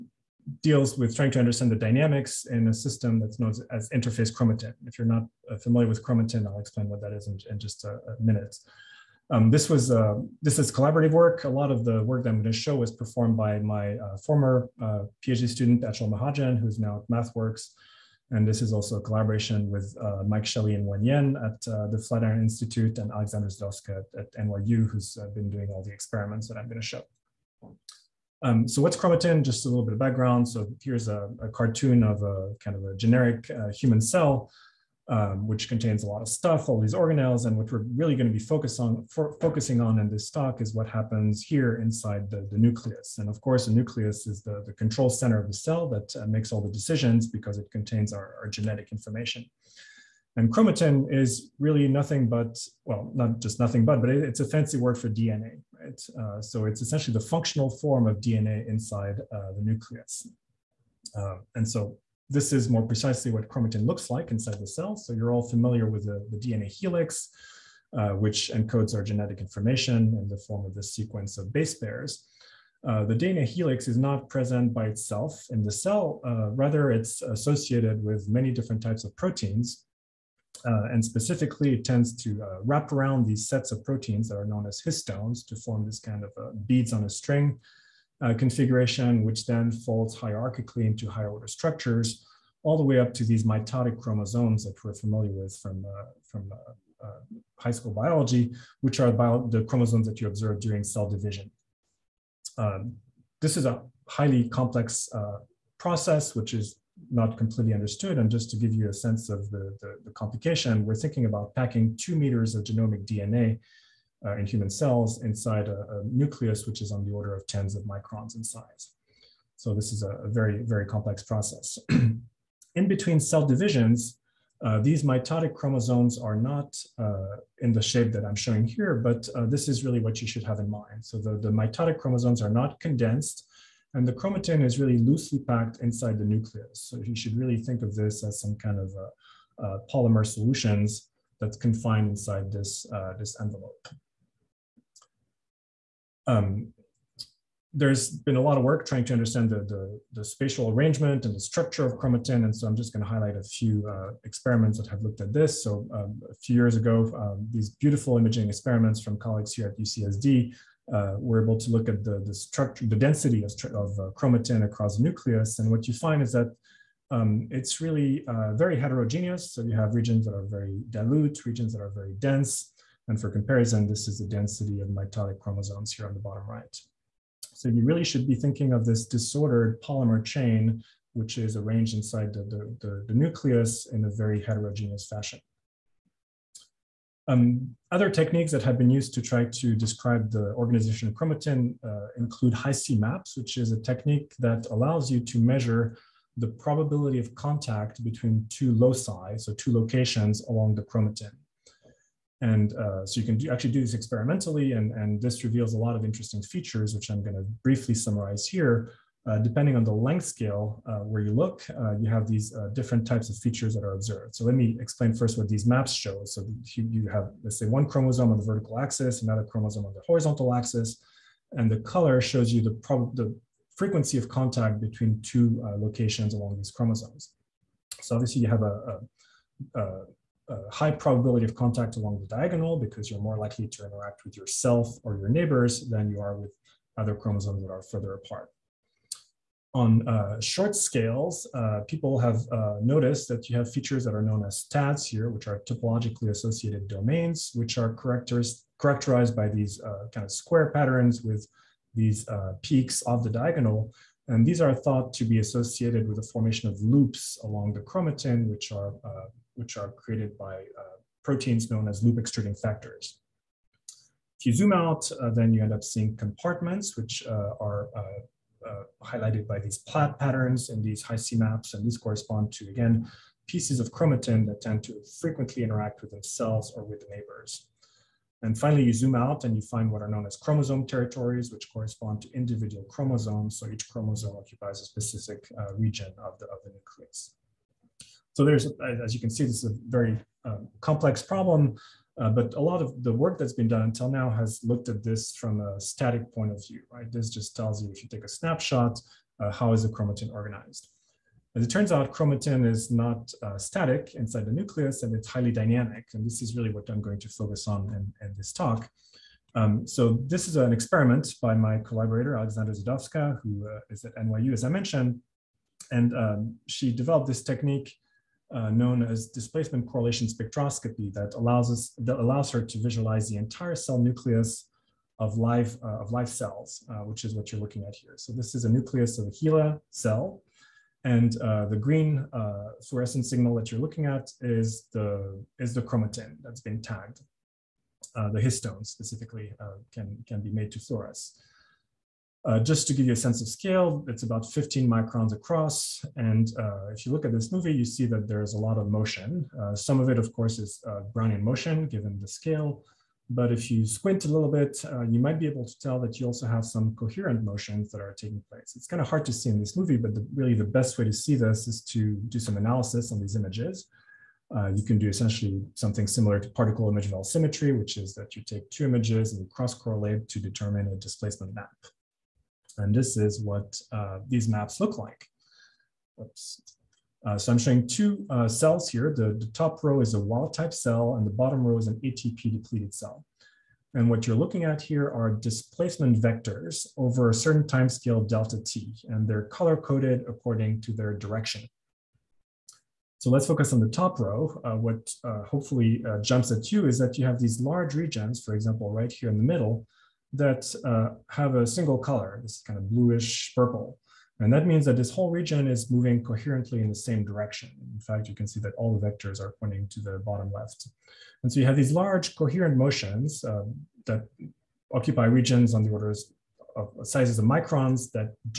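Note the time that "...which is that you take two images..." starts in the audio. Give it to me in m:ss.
6:07.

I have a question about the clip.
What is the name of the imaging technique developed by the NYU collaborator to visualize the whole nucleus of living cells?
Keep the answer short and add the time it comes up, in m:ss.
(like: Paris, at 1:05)
displacement correlation spectroscopy, at 5:19.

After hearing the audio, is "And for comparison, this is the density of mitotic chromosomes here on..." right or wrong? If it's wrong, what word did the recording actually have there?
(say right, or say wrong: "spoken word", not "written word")
right.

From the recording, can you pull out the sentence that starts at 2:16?
So you should really think of this as some kind of uh, uh, polymer solutions that's confined inside this, this envelope.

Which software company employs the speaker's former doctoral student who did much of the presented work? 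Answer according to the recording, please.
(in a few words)
MathWorks.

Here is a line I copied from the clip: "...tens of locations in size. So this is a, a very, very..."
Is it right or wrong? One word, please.
wrong.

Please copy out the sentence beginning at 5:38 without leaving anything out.
the histones specifically can can be made to fluoresce.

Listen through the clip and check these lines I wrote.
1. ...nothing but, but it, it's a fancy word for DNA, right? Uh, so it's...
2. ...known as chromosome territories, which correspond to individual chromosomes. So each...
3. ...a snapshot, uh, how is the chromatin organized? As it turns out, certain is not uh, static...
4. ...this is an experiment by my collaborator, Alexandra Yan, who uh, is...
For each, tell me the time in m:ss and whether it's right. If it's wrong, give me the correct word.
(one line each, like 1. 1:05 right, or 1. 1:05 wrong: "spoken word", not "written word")
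1. 0:53 right
2. 4:40 right
3. 4:58 wrong: "chromatin", not "certain"
4. 5:10 wrong: "Zidovska", not "Yan".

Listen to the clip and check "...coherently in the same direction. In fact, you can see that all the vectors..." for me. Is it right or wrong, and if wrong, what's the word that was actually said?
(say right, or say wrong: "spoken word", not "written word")
right.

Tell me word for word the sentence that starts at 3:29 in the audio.
Uh, depending on the length scale uh, where you look, uh, you have these uh, different types of features that are observed.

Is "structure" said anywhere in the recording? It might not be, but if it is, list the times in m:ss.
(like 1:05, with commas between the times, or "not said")
1:31, 2:31, 2:42.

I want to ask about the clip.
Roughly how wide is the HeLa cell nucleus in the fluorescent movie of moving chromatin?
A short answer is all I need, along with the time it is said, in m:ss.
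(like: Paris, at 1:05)
15 microns, at 5:44.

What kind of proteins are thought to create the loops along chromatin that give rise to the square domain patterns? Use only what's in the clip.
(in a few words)
loop extruding factors.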